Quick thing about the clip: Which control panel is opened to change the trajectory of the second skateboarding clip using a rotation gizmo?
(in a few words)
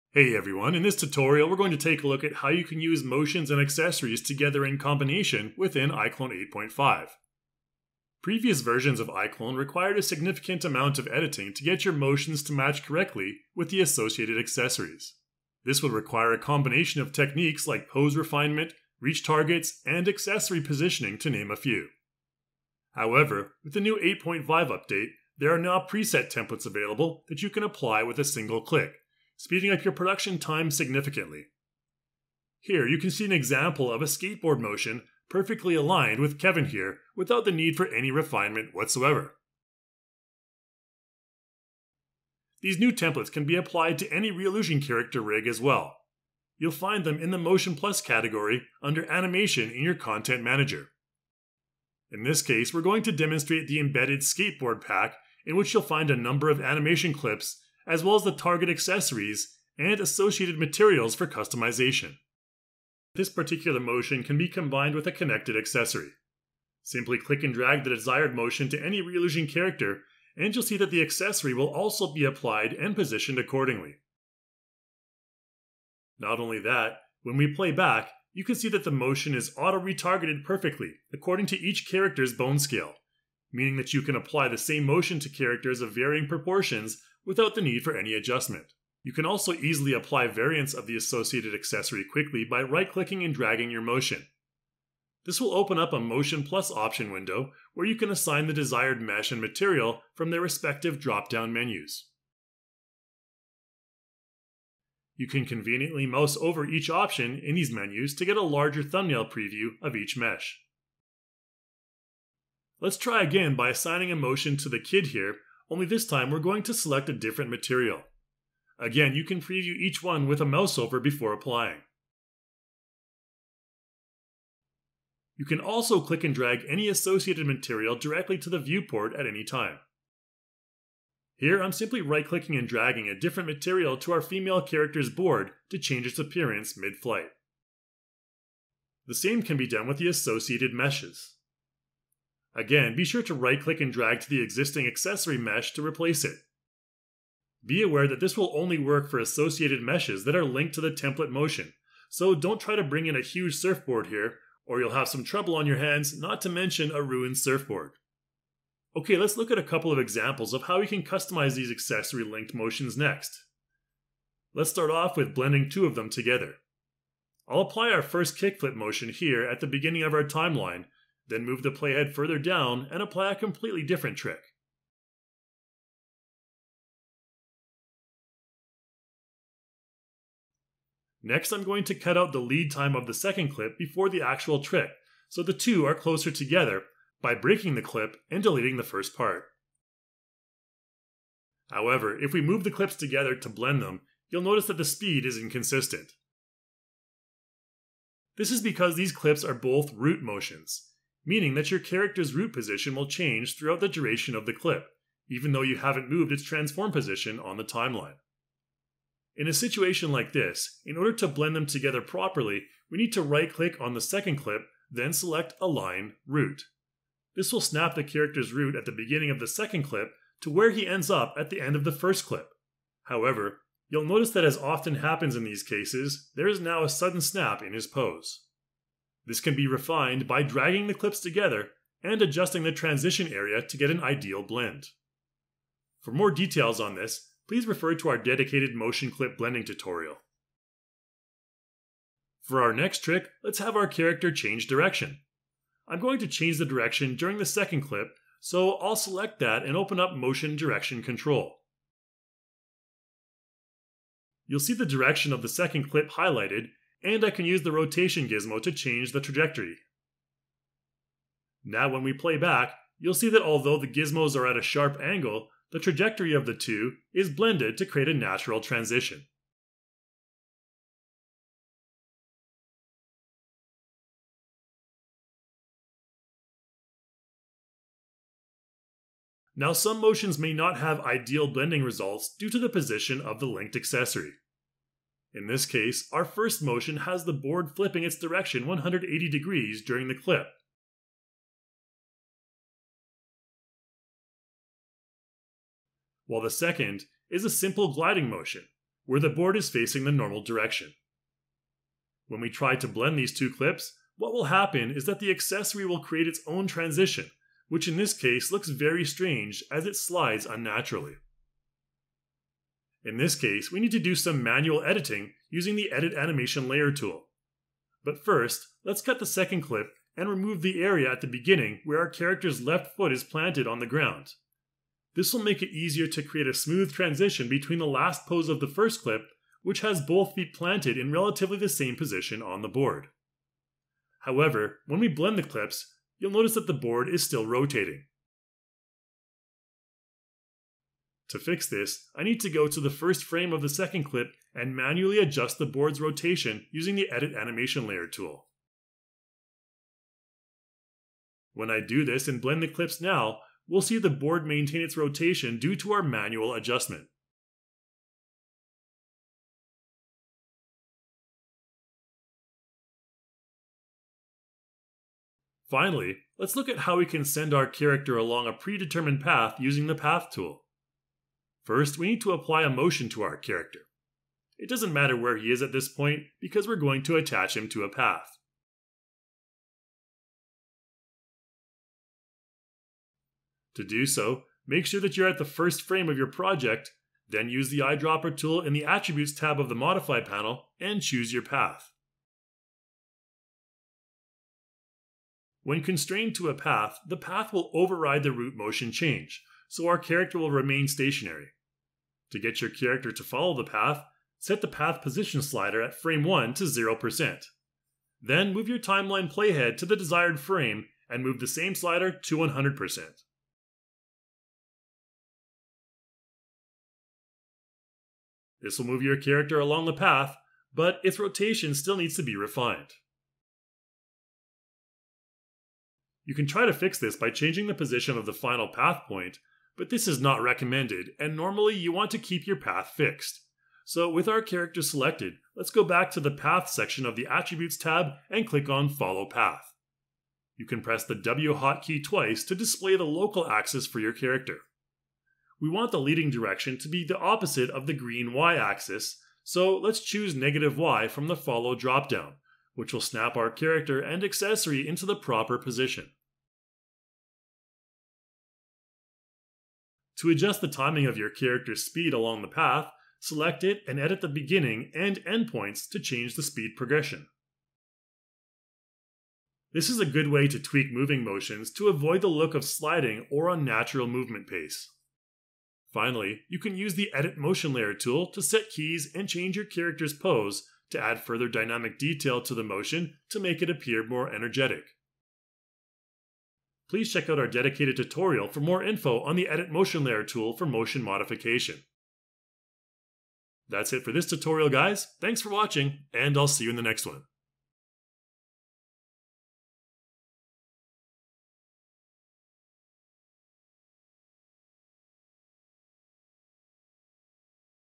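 Motion Direction Control.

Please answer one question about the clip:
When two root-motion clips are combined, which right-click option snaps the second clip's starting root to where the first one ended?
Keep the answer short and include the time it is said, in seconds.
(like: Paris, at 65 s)
Align Root, at 215 s.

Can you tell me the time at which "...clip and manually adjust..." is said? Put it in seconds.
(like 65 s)
344 s.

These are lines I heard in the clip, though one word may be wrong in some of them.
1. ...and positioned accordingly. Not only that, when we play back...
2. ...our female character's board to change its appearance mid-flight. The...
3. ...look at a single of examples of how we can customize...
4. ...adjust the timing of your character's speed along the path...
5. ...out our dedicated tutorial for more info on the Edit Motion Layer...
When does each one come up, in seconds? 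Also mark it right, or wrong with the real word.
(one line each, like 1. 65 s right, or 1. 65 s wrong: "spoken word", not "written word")
1. 72 s right
2. 134 s right
3. 159 s wrong: "couple", not "single"
4. 460 s right
5. 487 s right.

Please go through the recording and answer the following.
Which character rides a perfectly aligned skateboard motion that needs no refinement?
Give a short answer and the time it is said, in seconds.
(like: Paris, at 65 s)
Kevin, at 36 s.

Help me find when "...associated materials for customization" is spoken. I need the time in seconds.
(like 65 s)
59 s.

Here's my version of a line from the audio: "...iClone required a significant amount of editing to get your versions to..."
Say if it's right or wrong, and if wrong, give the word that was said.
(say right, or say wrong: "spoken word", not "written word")
wrong: "motions", not "versions".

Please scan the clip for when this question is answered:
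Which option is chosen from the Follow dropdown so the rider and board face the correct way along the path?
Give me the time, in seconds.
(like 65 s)
450 s.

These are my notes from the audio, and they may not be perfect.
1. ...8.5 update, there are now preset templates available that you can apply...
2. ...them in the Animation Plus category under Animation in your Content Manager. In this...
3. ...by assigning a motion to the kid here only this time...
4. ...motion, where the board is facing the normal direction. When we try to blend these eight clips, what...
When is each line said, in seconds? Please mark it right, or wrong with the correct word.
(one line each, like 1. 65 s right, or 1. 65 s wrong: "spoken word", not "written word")
1. 24 s right
2. 47 s wrong: "Motion", not "Animation"
3. 113 s right
4. 298 s wrong: "two", not "eight".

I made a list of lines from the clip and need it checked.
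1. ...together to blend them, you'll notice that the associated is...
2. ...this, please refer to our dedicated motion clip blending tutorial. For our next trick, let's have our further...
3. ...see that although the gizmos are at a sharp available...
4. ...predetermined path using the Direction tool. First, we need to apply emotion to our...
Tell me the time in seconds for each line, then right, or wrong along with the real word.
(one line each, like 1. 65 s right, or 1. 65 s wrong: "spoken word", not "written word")
1. 192 s wrong: "speed", not "associated"
2. 236 s wrong: "character", not "further"
3. 263 s wrong: "angle", not "available"
4. 368 s wrong: "Path", not "Direction".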